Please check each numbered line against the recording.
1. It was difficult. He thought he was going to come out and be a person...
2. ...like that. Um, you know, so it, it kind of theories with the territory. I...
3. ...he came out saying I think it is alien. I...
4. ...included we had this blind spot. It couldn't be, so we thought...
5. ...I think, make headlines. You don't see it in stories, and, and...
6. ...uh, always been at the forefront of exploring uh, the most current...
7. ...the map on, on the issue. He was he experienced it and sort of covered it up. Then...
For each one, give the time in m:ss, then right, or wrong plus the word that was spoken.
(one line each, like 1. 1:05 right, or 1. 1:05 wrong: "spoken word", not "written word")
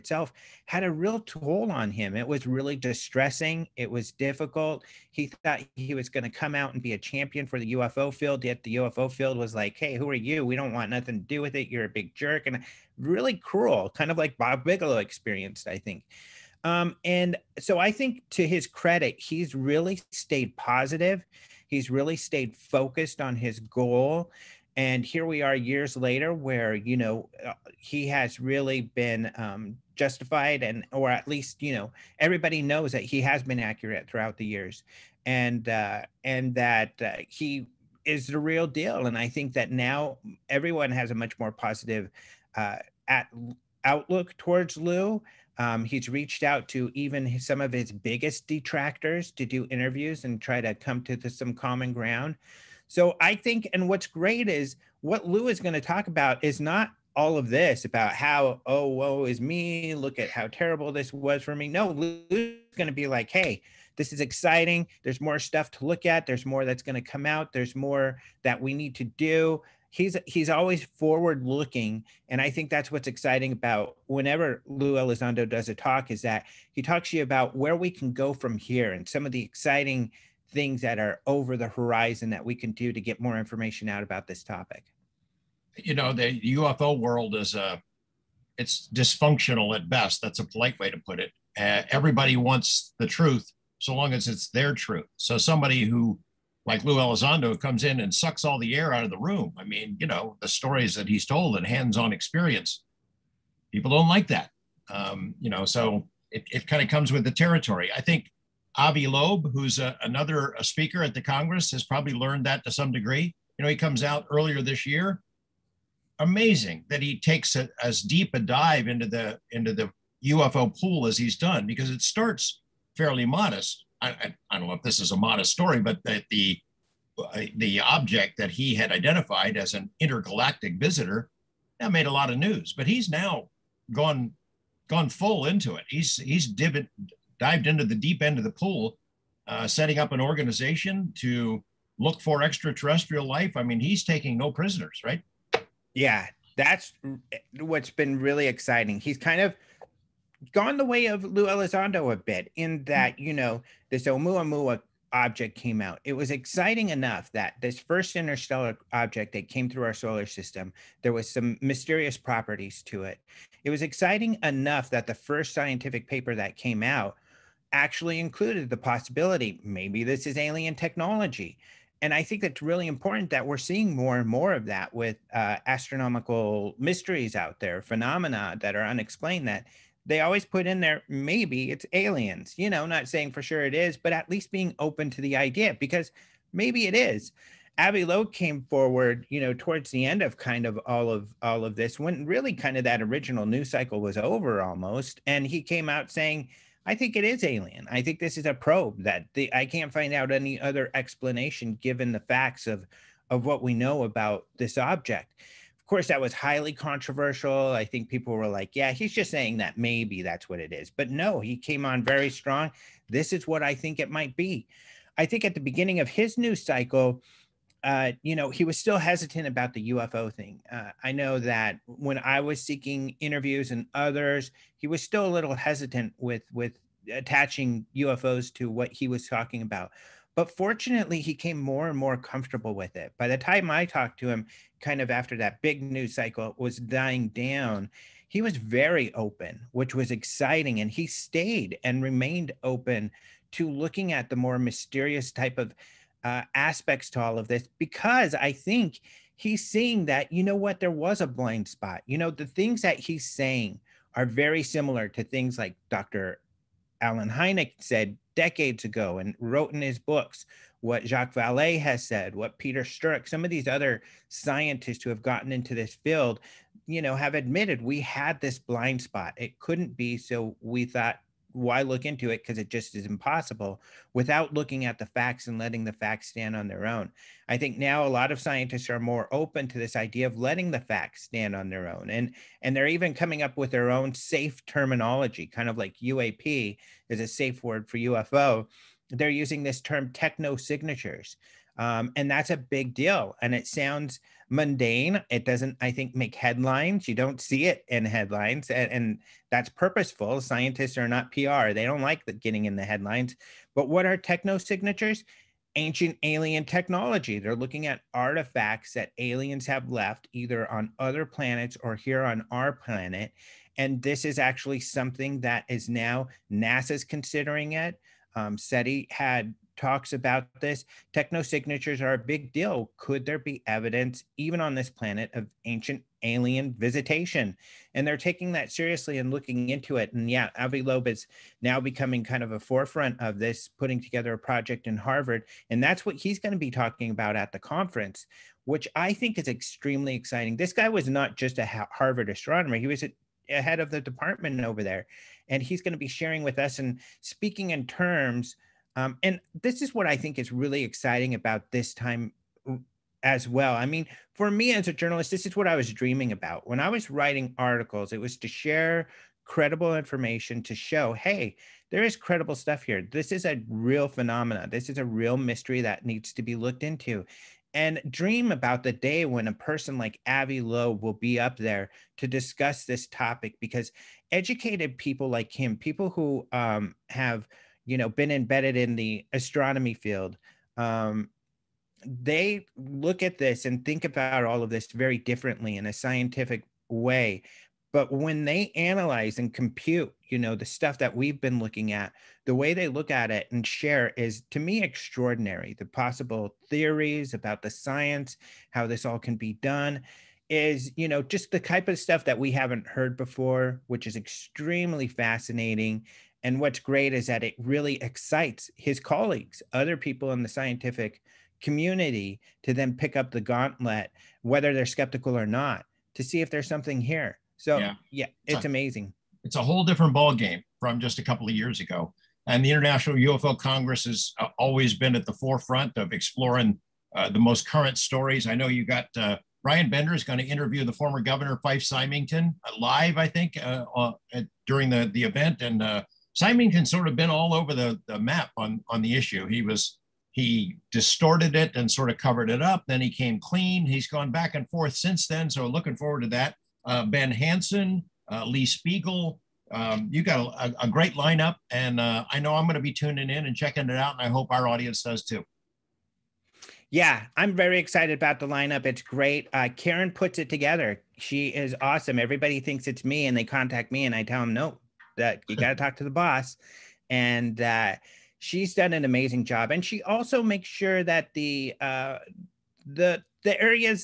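1. 0:03 wrong: "champion", not "person"
2. 1:44 wrong: "comes", not "theories"
3. 3:15 right
4. 4:27 wrong: "admitted", not "included"
5. 4:55 wrong: "headlines", not "stories"
6. 7:04 right
7. 7:18 wrong: "distorted", not "experienced".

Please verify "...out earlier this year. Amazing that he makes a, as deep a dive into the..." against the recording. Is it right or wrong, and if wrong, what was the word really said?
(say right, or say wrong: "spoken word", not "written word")
wrong: "takes", not "makes".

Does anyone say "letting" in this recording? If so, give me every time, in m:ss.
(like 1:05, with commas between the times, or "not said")
4:35, 4:40.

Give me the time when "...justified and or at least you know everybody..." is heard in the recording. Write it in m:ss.
0:29.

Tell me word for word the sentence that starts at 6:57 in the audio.
So yeah, yeah it's, it's a, amazing.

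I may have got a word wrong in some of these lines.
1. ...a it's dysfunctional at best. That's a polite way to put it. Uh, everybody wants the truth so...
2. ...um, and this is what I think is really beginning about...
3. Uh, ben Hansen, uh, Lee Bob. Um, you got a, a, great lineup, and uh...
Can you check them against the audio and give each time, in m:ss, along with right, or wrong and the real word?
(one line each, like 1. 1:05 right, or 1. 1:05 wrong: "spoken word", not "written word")
1. 1:27 right
2. 5:49 wrong: "exciting", not "beginning"
3. 7:26 wrong: "Spiegel", not "Bob".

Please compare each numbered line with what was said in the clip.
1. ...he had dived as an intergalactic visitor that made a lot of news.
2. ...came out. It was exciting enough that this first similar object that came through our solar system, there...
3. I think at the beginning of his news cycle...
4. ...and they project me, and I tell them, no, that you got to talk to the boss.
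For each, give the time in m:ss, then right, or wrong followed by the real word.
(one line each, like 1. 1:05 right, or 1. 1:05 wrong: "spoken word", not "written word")
1. 2:08 wrong: "identified", not "dived"
2. 2:35 wrong: "interstellar", not "similar"
3. 3:35 right
4. 7:43 wrong: "contact", not "project".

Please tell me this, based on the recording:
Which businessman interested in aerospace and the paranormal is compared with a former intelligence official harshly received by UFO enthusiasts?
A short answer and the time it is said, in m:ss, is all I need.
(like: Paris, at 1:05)
Bob Bigelow, at 0:14.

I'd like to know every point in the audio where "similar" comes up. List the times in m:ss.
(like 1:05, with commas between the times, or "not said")
4:14.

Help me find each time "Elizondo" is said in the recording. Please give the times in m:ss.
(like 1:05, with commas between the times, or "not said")
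1:14, 1:36, 2:31.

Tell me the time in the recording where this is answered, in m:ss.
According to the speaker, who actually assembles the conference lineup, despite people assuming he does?
7:39.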